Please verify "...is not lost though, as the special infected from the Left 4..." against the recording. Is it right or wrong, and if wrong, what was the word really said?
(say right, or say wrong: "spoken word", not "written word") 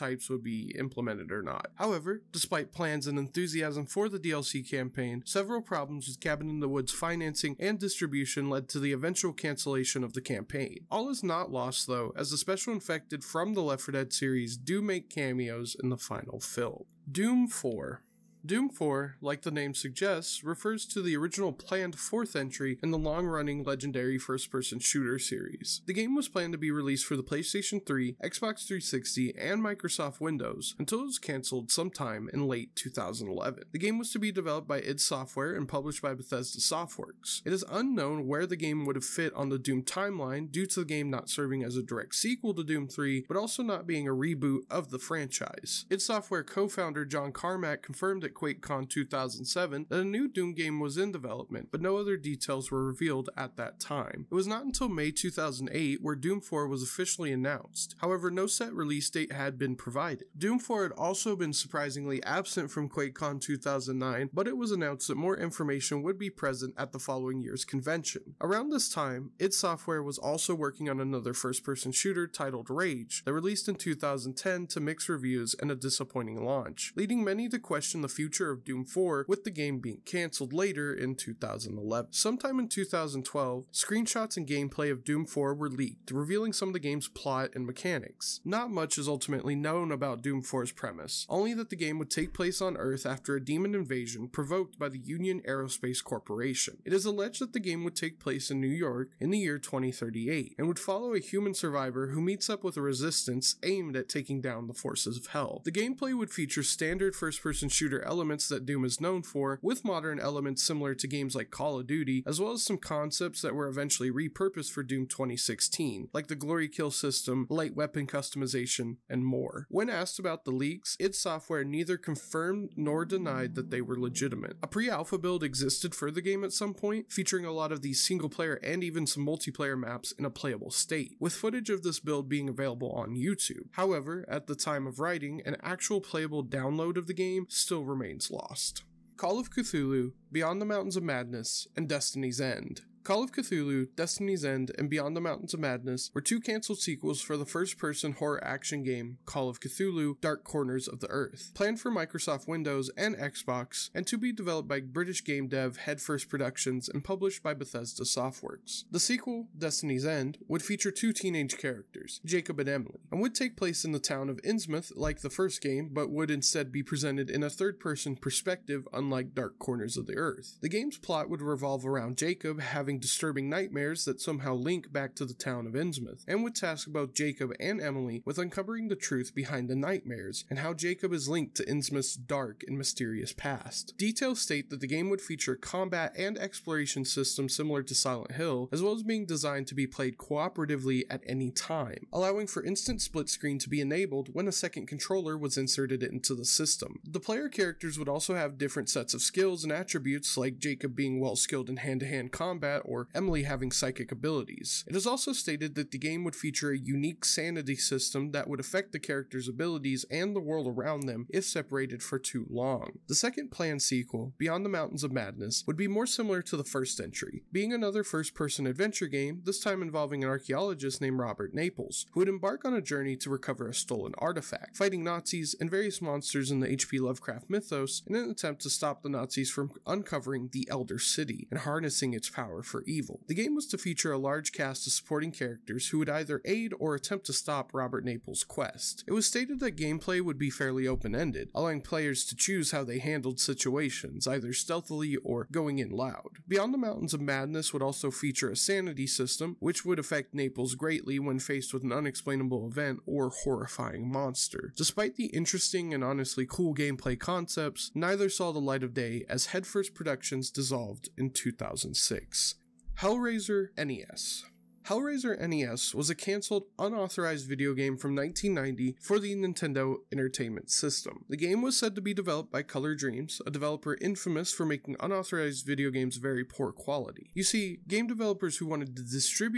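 right.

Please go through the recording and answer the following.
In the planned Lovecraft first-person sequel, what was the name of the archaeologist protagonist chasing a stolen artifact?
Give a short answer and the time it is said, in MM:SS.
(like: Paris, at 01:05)
Robert Naples, at 03:41.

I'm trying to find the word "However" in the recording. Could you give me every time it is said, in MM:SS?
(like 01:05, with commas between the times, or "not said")
00:01, 00:57, 02:13.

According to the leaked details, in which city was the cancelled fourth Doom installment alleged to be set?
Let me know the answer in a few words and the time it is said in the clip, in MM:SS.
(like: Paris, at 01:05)
New York, at 01:38.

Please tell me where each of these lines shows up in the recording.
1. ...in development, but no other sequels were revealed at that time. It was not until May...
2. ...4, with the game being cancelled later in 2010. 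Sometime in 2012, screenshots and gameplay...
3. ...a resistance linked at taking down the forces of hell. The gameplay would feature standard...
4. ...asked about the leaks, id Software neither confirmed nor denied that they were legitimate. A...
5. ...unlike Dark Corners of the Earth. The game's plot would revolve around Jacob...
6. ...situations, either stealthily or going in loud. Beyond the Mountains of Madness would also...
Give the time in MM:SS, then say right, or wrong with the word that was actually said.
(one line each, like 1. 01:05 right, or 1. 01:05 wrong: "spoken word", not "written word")
1. 00:50 wrong: "details", not "sequels"
2. 01:18 wrong: "2011", not "2010"
3. 01:42 wrong: "aimed", not "linked"
4. 01:59 right
5. 02:48 right
6. 04:03 right.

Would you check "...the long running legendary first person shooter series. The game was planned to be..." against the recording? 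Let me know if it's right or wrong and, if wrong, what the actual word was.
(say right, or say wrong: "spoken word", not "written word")
right.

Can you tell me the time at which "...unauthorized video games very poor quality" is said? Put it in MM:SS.
04:34.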